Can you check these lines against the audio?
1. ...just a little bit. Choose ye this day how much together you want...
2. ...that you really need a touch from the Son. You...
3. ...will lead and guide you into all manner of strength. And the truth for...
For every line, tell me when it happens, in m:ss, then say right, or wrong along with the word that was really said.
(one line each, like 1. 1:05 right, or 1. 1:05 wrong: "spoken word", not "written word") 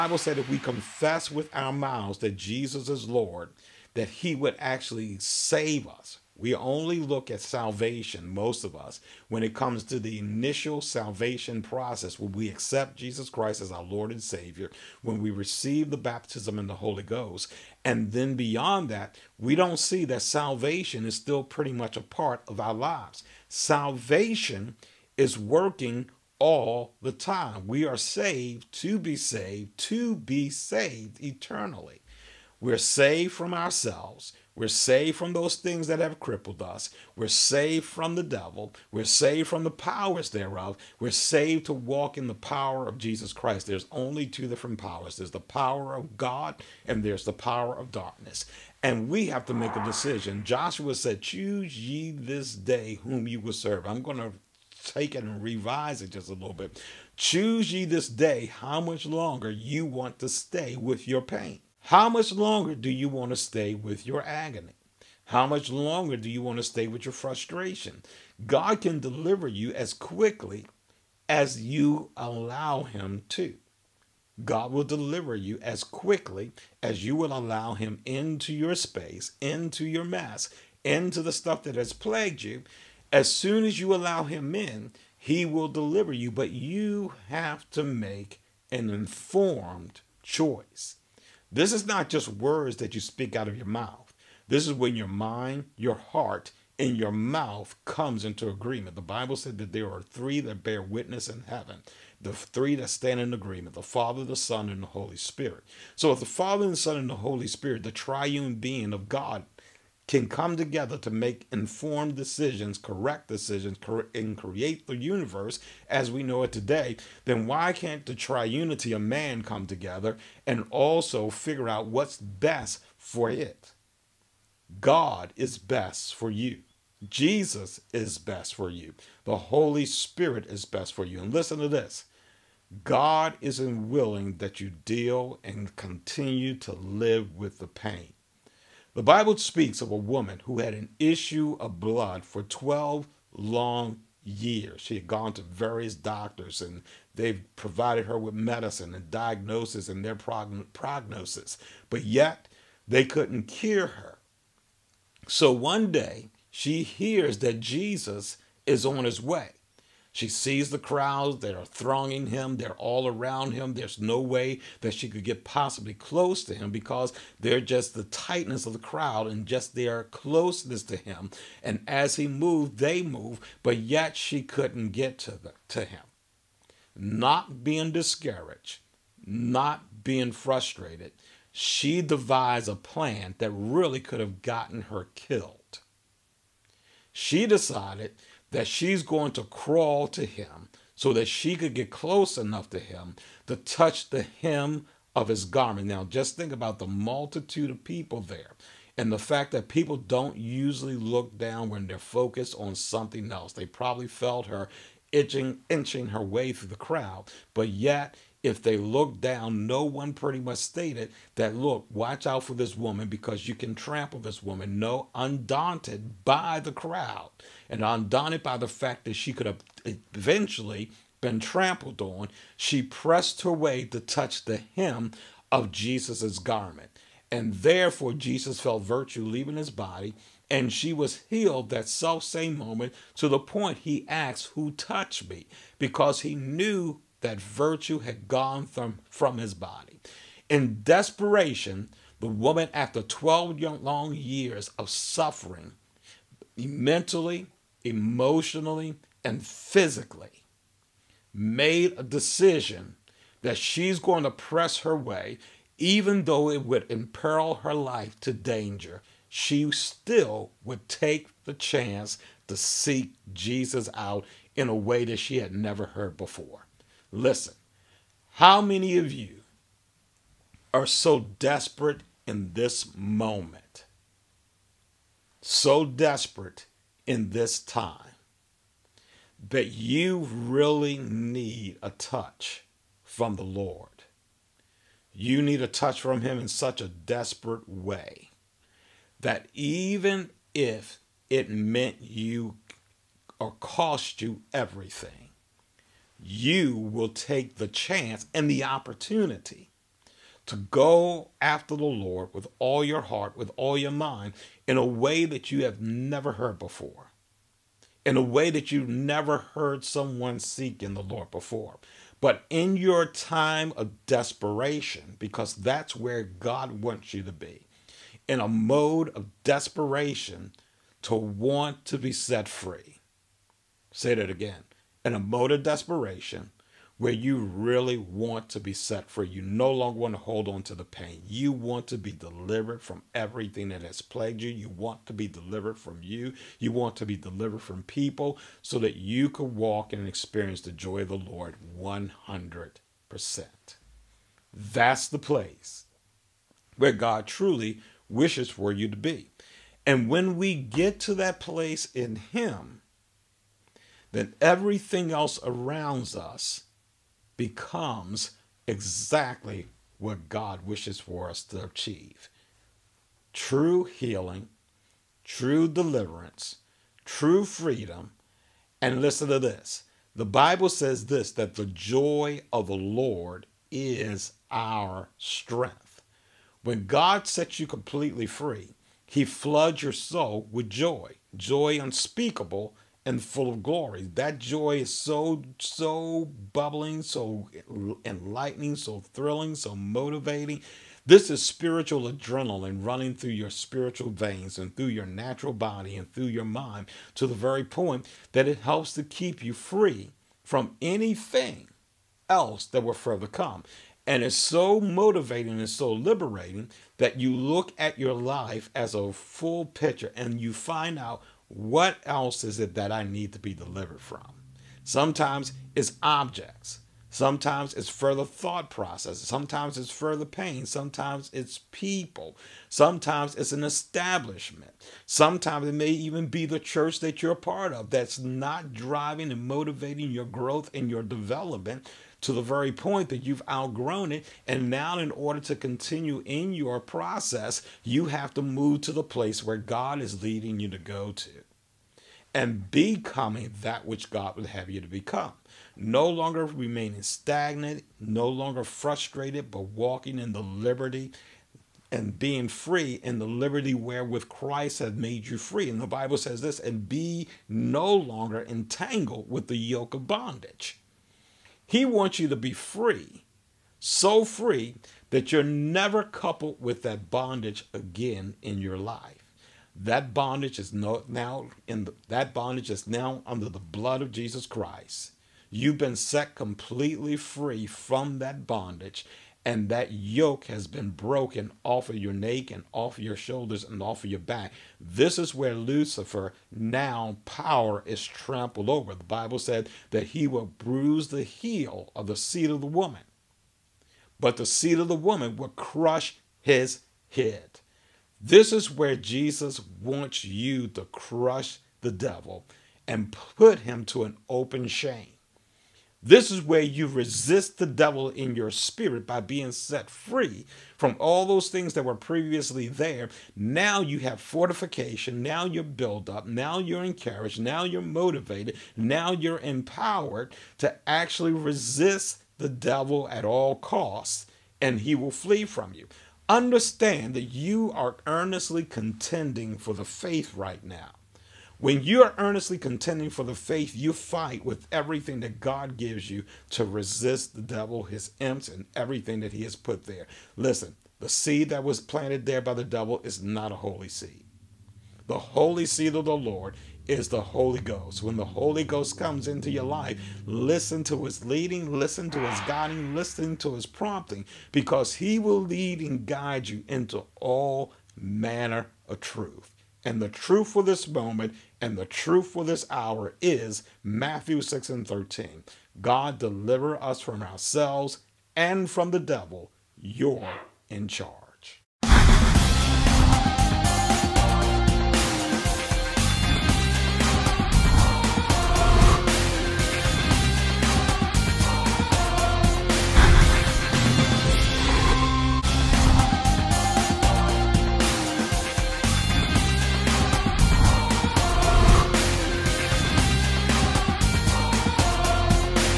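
1. 0:56 wrong: "longer", not "together"
2. 4:39 wrong: "Lord", not "Son"
3. 9:15 wrong: "truth", not "strength".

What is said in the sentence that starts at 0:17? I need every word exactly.
And then beyond that, we don't see that salvation is still pretty much a part of our lives.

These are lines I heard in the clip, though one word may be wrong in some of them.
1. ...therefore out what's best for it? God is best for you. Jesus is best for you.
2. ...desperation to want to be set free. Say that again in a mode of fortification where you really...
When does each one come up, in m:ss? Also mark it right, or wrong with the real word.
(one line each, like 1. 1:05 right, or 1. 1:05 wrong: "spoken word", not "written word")
1. 2:01 wrong: "figure", not "therefore"
2. 5:19 wrong: "desperation", not "fortification".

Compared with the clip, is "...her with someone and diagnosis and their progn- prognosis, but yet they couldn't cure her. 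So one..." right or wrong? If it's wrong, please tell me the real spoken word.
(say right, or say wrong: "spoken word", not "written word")
wrong: "medicine", not "someone".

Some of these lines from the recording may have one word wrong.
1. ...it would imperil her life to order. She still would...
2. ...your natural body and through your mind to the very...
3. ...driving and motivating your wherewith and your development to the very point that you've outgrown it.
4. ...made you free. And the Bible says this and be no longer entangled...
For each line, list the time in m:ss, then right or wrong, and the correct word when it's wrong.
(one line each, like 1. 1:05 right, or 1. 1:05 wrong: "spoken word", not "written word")
1. 4:16 wrong: "danger", not "order"
2. 6:34 right
3. 7:08 wrong: "growth", not "wherewith"
4. 7:34 right.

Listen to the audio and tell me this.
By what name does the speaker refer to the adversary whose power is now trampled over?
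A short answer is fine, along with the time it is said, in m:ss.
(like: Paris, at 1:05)
Lucifer, at 8:05.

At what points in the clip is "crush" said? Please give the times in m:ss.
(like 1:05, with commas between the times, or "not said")
8:15, 8:20.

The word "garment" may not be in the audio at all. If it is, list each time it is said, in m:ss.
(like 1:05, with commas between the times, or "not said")
3:15, 3:46.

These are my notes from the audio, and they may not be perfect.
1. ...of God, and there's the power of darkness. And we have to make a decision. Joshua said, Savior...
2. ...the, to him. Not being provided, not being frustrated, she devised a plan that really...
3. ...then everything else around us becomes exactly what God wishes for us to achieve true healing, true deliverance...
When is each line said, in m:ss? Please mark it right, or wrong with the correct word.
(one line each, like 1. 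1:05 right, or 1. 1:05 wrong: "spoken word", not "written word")
1. 0:45 wrong: "Choose", not "Savior"
2. 2:55 wrong: "discouraged", not "provided"
3. 5:54 right.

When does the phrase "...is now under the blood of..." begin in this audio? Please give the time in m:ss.
7:52.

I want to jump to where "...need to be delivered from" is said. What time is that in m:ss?
6:53.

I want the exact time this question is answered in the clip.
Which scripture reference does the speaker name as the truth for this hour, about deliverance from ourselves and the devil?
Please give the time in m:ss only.
9:23.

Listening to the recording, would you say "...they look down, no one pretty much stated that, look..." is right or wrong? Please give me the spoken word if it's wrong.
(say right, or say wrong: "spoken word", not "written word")
right.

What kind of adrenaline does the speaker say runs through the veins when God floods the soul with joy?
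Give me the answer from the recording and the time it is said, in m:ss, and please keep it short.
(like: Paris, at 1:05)
Spiritual adrenaline, at 6:31.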